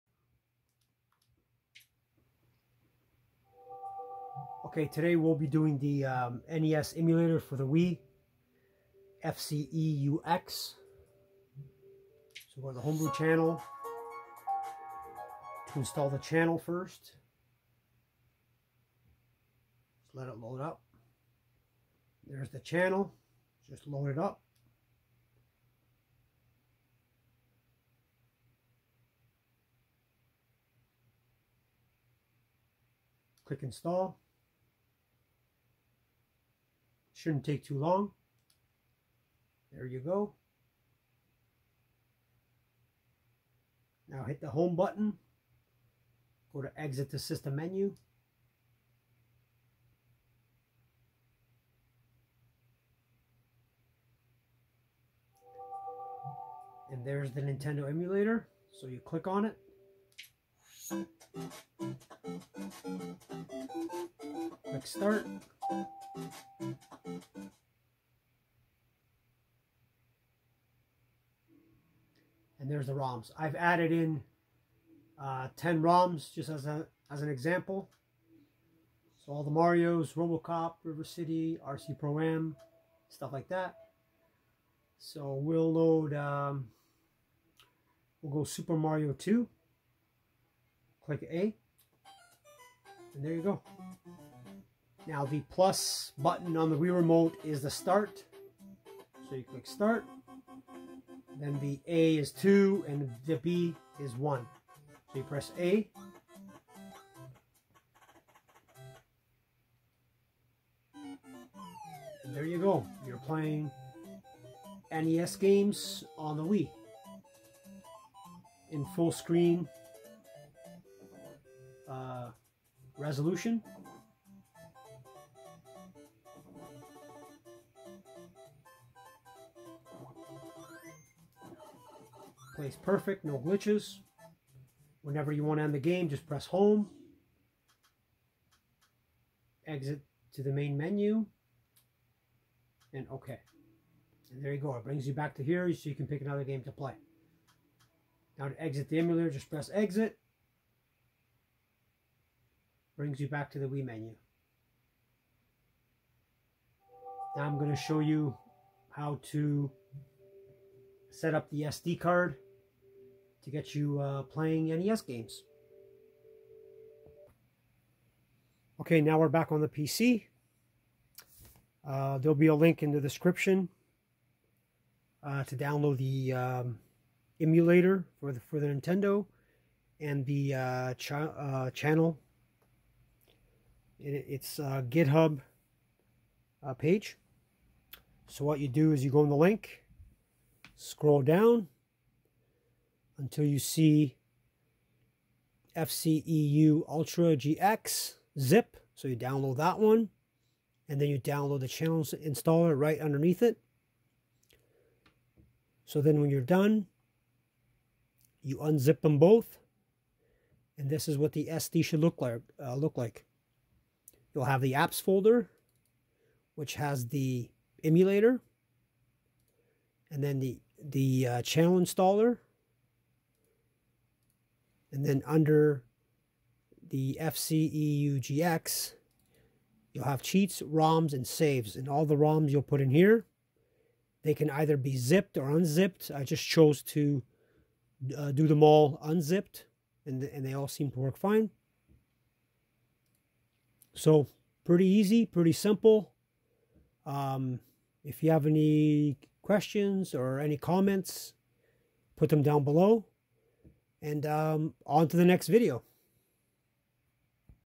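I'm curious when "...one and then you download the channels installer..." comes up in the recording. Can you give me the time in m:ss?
3:19.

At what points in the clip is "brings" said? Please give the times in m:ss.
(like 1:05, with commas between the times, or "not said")
2:24, 2:32.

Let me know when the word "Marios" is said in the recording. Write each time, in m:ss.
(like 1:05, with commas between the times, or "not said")
1:19, 1:28.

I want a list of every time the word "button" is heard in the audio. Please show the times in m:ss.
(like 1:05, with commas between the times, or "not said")
0:44, 1:36.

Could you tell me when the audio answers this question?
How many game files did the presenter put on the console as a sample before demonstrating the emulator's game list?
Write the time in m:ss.
1:15.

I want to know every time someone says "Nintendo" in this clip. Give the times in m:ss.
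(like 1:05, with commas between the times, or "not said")
0:57, 2:58.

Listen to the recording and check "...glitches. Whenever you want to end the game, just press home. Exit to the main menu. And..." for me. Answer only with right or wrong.
right.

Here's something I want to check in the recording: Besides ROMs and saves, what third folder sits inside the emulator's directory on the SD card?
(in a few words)
Cheats.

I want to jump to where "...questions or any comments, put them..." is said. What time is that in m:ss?
4:09.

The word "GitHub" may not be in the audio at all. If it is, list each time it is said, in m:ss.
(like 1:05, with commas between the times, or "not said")
3:04.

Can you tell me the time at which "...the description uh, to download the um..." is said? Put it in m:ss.
2:52.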